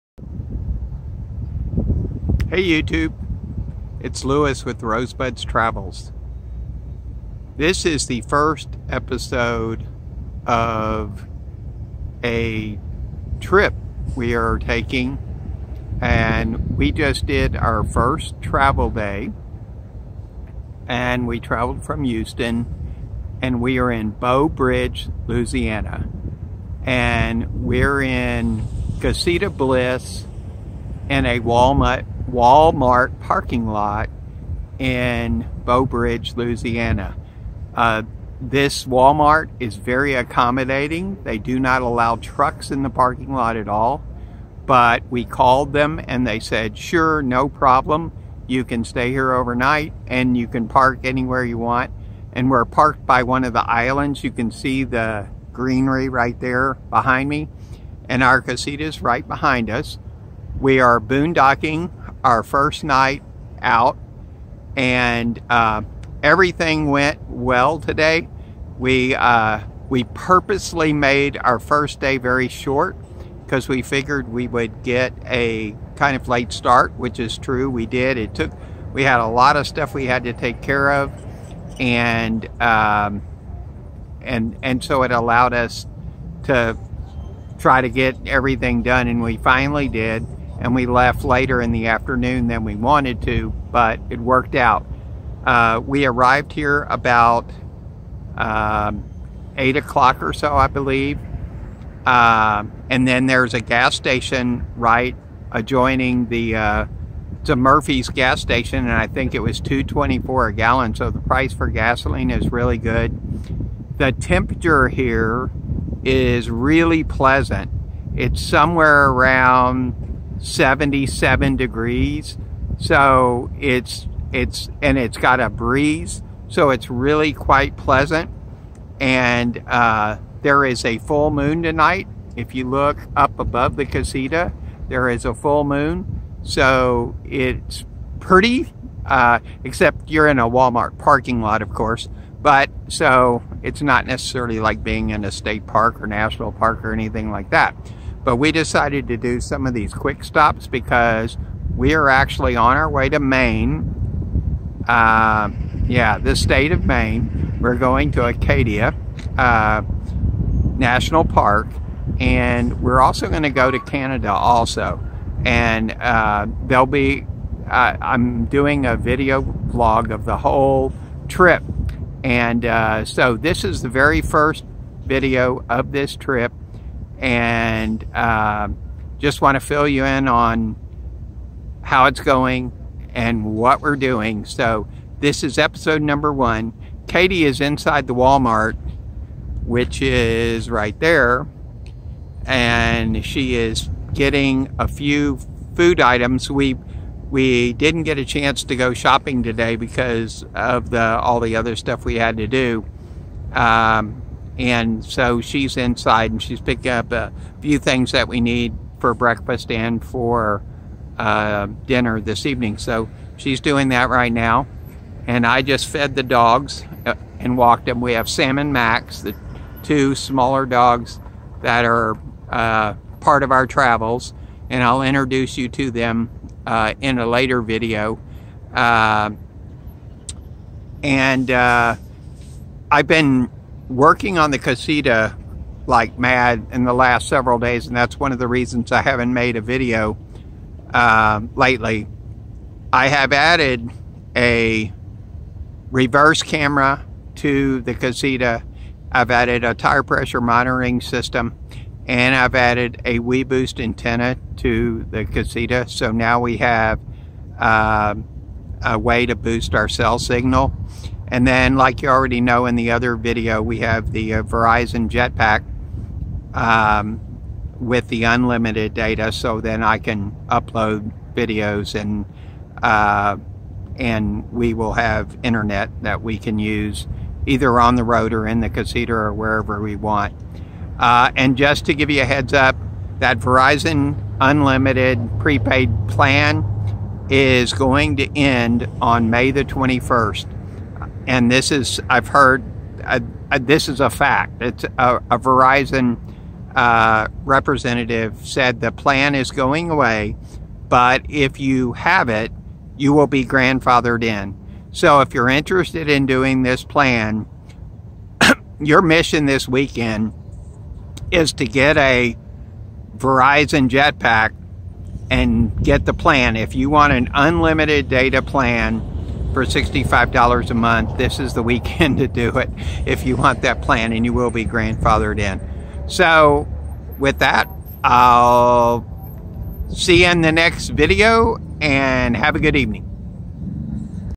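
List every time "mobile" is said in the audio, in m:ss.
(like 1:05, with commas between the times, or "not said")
not said.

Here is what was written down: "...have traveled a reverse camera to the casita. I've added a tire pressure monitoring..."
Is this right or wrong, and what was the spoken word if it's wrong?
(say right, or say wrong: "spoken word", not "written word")
wrong: "added", not "traveled".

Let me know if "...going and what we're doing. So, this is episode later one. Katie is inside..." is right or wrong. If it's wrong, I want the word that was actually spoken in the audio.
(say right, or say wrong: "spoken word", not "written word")
wrong: "number", not "later".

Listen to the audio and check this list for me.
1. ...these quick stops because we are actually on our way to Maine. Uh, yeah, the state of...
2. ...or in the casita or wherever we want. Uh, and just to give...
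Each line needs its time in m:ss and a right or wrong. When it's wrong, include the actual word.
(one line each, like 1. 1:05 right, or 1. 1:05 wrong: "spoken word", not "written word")
1. 2:29 right
2. 4:38 right.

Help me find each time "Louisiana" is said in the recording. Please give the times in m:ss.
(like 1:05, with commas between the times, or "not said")
0:25, 0:36.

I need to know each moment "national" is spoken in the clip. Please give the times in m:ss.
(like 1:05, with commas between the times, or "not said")
2:26, 2:40.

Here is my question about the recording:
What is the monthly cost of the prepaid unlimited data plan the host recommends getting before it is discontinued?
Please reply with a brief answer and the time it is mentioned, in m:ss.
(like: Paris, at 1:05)
$65, at 5:19.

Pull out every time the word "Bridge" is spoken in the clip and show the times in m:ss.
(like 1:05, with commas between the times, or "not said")
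0:24, 0:35.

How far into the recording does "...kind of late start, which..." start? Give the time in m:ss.
1:15.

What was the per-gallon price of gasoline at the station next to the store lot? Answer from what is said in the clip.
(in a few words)
$2.24.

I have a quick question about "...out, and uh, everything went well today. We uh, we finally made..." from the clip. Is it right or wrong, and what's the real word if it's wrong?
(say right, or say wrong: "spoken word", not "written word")
wrong: "purposely", not "finally".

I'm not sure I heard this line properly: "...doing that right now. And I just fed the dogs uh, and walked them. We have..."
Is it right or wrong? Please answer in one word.
right.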